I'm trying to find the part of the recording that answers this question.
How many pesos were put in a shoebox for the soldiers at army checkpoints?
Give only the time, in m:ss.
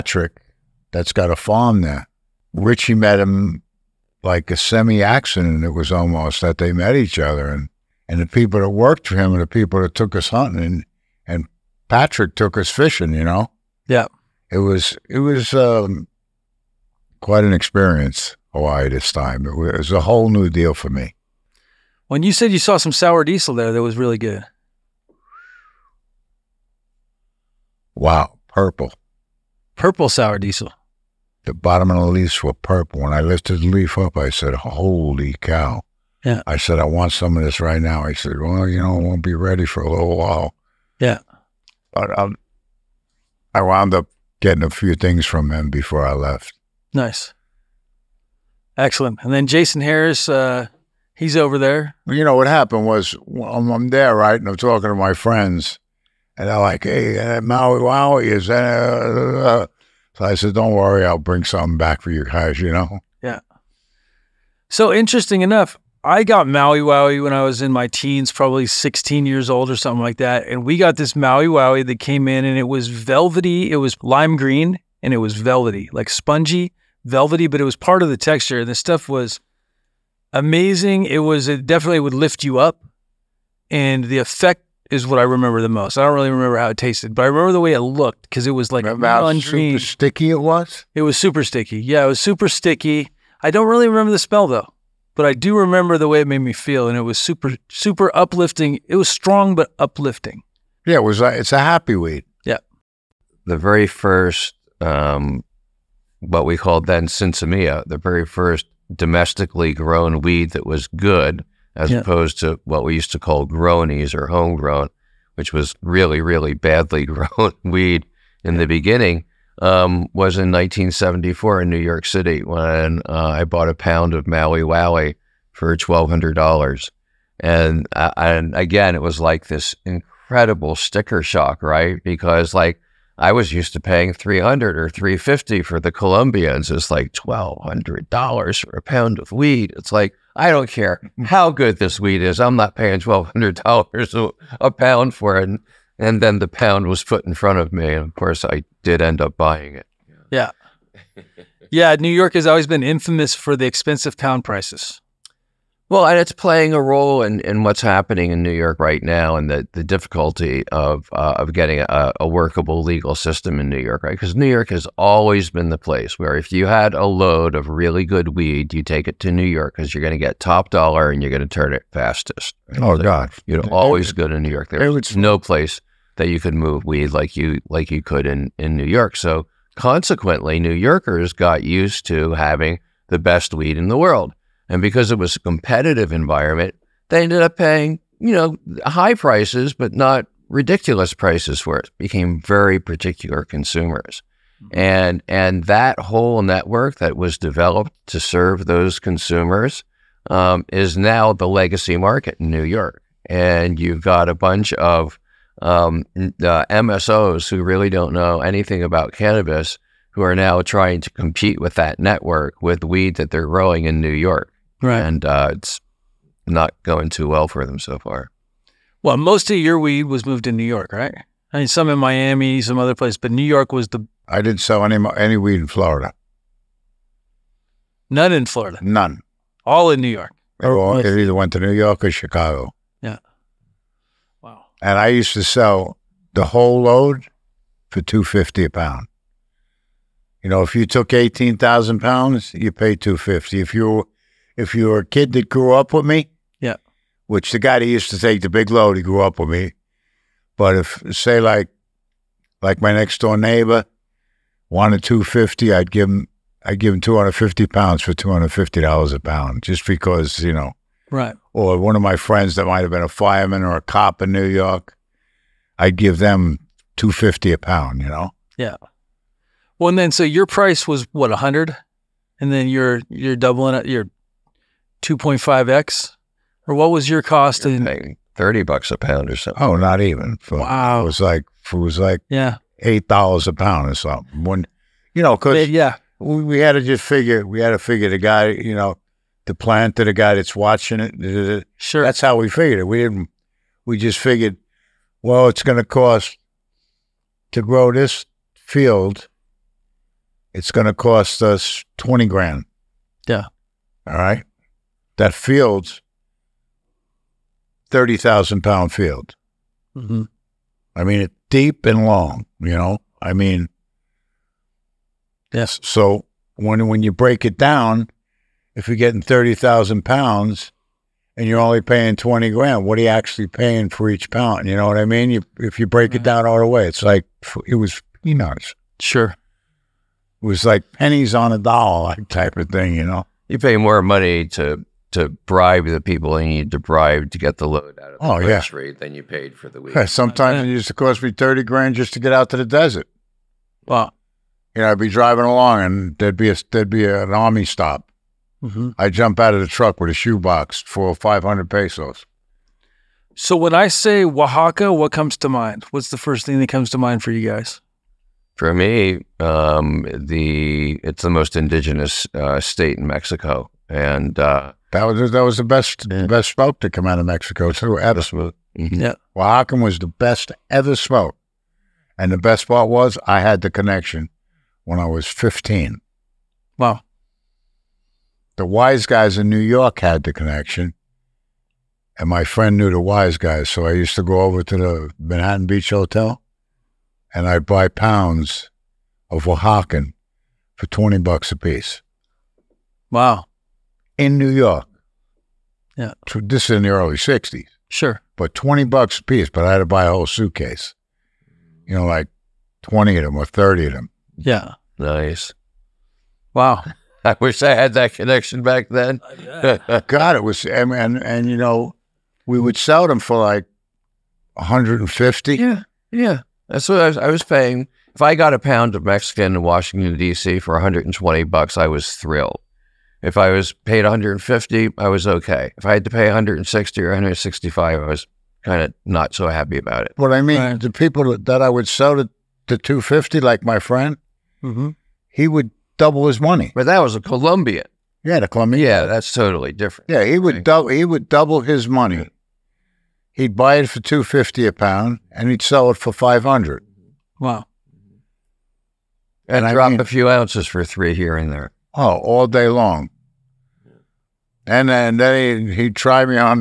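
5:51.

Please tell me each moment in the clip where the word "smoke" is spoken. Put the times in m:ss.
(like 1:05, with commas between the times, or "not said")
6:06, 6:10.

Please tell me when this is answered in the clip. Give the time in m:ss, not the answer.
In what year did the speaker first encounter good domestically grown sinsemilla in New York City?
2:00.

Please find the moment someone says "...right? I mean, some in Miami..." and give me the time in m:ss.
3:40.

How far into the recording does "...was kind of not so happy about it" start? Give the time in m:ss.
7:08.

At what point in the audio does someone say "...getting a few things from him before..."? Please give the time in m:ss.
0:44.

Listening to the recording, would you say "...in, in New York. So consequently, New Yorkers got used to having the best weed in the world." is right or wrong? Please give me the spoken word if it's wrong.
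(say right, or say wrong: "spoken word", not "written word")
right.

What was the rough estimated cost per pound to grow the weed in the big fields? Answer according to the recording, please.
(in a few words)
$8.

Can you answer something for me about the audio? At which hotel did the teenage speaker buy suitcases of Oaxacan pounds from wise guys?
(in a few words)
Manhattan Beach Hotel.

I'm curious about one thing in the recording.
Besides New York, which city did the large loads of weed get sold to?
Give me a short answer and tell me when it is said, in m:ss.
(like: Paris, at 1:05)
Chicago, at 3:52.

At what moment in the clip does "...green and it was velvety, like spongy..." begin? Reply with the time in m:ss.
1:14.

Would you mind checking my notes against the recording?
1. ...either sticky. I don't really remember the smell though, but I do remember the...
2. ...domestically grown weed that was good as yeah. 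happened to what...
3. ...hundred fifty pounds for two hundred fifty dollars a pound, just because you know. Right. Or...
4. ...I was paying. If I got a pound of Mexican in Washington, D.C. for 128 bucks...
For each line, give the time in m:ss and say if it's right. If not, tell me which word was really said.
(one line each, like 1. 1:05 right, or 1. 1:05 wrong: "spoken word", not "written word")
1. 1:32 wrong: "super", not "either"
2. 1:48 wrong: "opposed", not "happened"
3. 4:17 right
4. 6:57 wrong: "120", not "128".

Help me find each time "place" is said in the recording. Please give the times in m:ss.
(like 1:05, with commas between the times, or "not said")
2:45, 2:55, 3:42.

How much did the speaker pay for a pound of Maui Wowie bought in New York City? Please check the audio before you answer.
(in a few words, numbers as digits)
$1,200.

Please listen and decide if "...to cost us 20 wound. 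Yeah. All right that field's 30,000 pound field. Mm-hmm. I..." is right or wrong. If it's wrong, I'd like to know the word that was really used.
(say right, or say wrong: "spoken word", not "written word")
wrong: "grand", not "wound".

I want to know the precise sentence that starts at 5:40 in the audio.
sometimes it used to cost me 30 grand just to get out to the desert.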